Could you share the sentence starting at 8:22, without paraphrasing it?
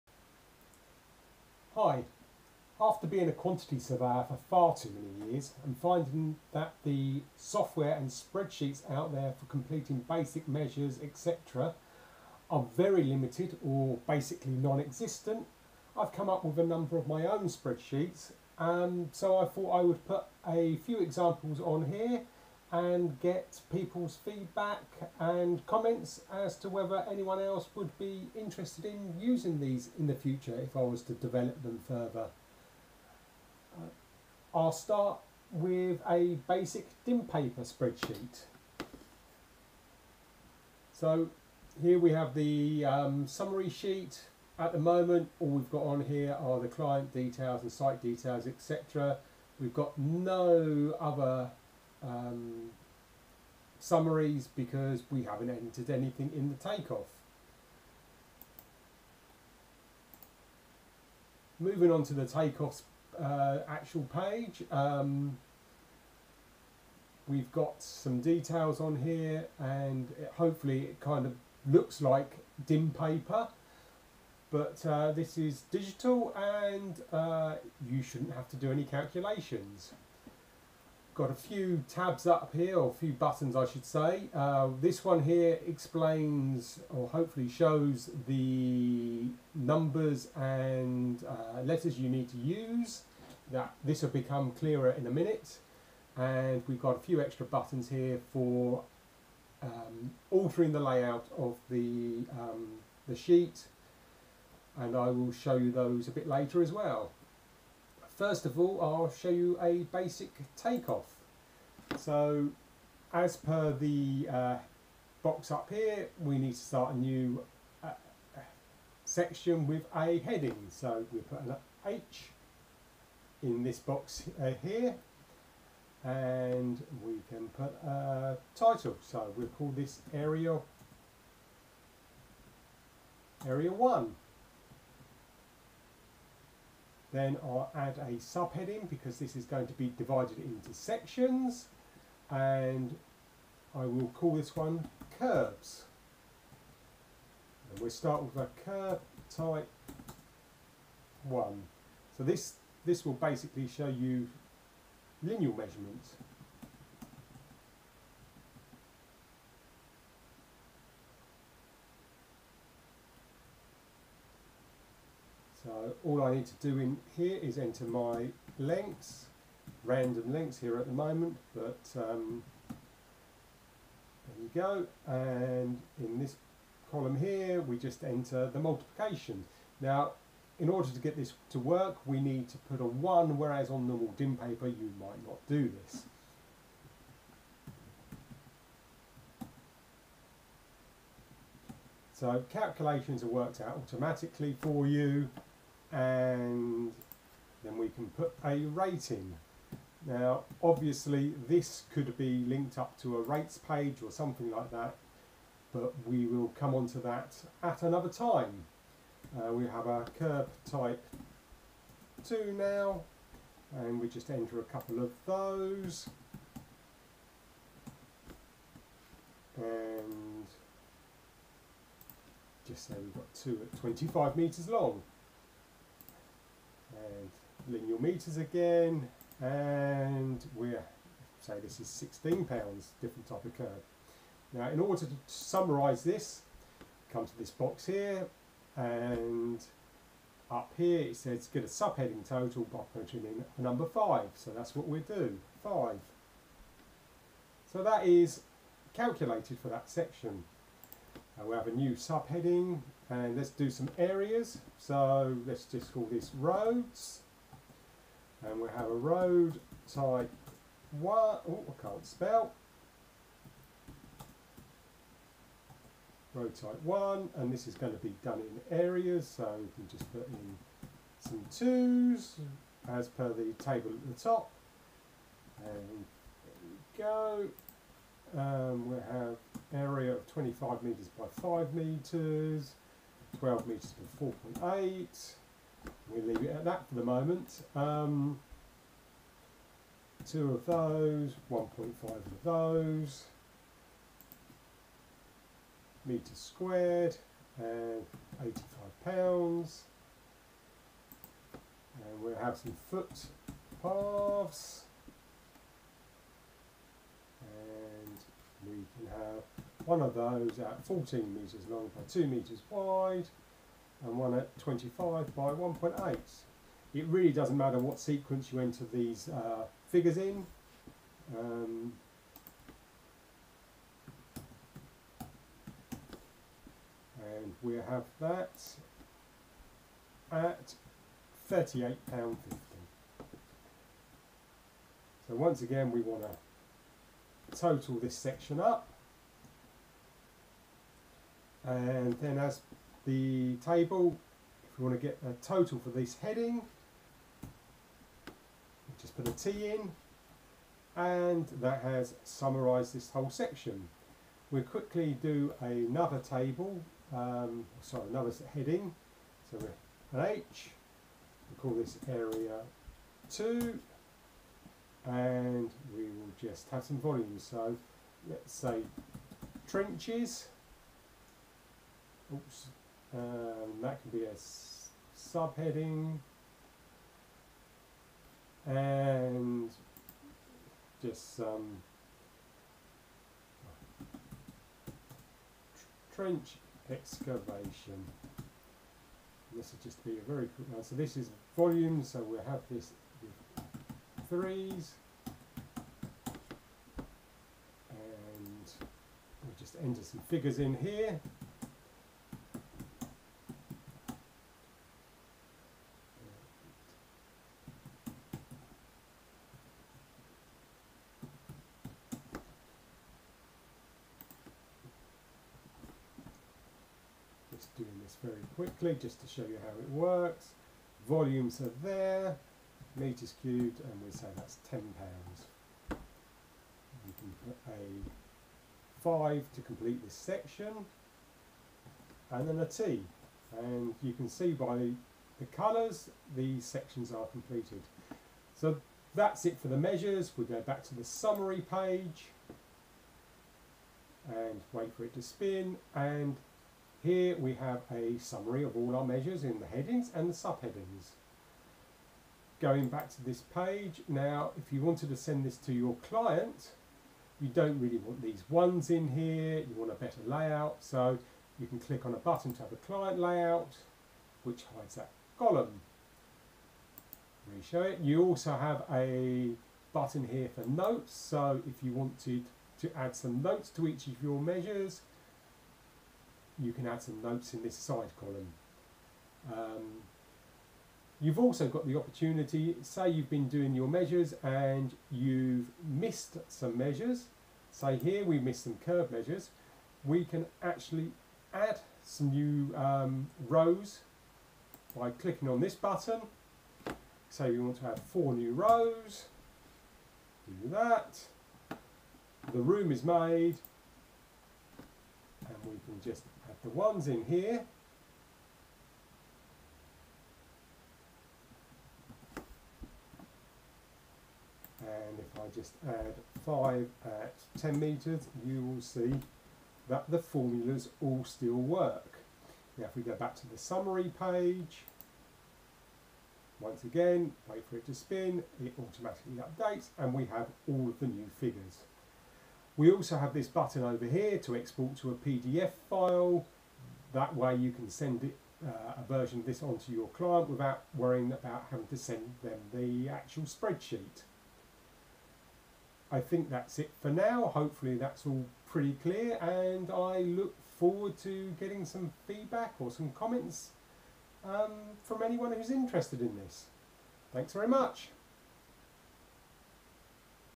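The room is made and we can just the one's in here.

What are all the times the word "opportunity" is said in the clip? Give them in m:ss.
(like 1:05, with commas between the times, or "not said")
8:01.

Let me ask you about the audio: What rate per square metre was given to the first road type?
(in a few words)
£85.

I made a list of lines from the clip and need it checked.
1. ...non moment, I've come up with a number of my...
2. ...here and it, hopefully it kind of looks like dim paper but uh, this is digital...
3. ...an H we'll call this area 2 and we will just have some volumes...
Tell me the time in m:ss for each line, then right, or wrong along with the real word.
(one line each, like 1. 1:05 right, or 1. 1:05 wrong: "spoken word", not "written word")
1. 0:14 wrong: "existent", not "moment"
2. 1:08 right
3. 6:00 right.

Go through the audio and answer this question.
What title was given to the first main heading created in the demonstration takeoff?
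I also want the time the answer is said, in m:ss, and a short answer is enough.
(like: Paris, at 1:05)
Area 1, at 2:13.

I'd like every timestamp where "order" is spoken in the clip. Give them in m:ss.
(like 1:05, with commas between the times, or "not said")
3:00, 3:54.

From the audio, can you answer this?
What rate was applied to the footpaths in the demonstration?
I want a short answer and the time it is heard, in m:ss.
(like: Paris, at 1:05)
£38.50, at 5:31.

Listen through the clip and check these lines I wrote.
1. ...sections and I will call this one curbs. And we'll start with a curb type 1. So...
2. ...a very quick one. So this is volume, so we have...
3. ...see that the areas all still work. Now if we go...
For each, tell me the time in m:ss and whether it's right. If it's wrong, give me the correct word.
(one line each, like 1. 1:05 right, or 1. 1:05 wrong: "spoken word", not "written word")
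1. 2:20 right
2. 6:30 right
3. 8:38 wrong: "formulas", not "areas".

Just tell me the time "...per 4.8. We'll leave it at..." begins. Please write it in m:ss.
4:44.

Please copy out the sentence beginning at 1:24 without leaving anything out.
Uh, this one here explains, or hopefully shows, the numbers and uh, letters you need to use.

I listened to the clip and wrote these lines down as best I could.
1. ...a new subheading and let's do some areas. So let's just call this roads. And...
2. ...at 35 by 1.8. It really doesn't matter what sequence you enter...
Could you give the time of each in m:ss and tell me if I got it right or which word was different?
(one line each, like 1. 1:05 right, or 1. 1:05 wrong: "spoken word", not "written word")
1. 4:11 right
2. 5:14 wrong: "25", not "35".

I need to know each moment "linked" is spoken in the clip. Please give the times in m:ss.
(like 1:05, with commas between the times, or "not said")
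3:22.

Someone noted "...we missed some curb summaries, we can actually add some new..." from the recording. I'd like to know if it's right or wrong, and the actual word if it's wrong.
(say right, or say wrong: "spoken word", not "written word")
wrong: "measures", not "summaries".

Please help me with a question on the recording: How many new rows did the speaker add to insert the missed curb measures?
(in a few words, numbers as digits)
4.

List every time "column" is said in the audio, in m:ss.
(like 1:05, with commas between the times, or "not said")
2:56, 7:45, 7:58.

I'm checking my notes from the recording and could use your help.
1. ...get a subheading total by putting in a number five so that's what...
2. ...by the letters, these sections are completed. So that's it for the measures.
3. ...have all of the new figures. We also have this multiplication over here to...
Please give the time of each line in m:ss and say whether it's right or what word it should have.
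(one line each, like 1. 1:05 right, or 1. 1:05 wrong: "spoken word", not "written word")
1. 4:01 right
2. 7:14 wrong: "colours", not "letters"
3. 8:50 wrong: "button", not "multiplication".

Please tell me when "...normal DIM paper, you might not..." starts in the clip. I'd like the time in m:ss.
3:03.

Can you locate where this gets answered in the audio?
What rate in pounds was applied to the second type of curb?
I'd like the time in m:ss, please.
3:51.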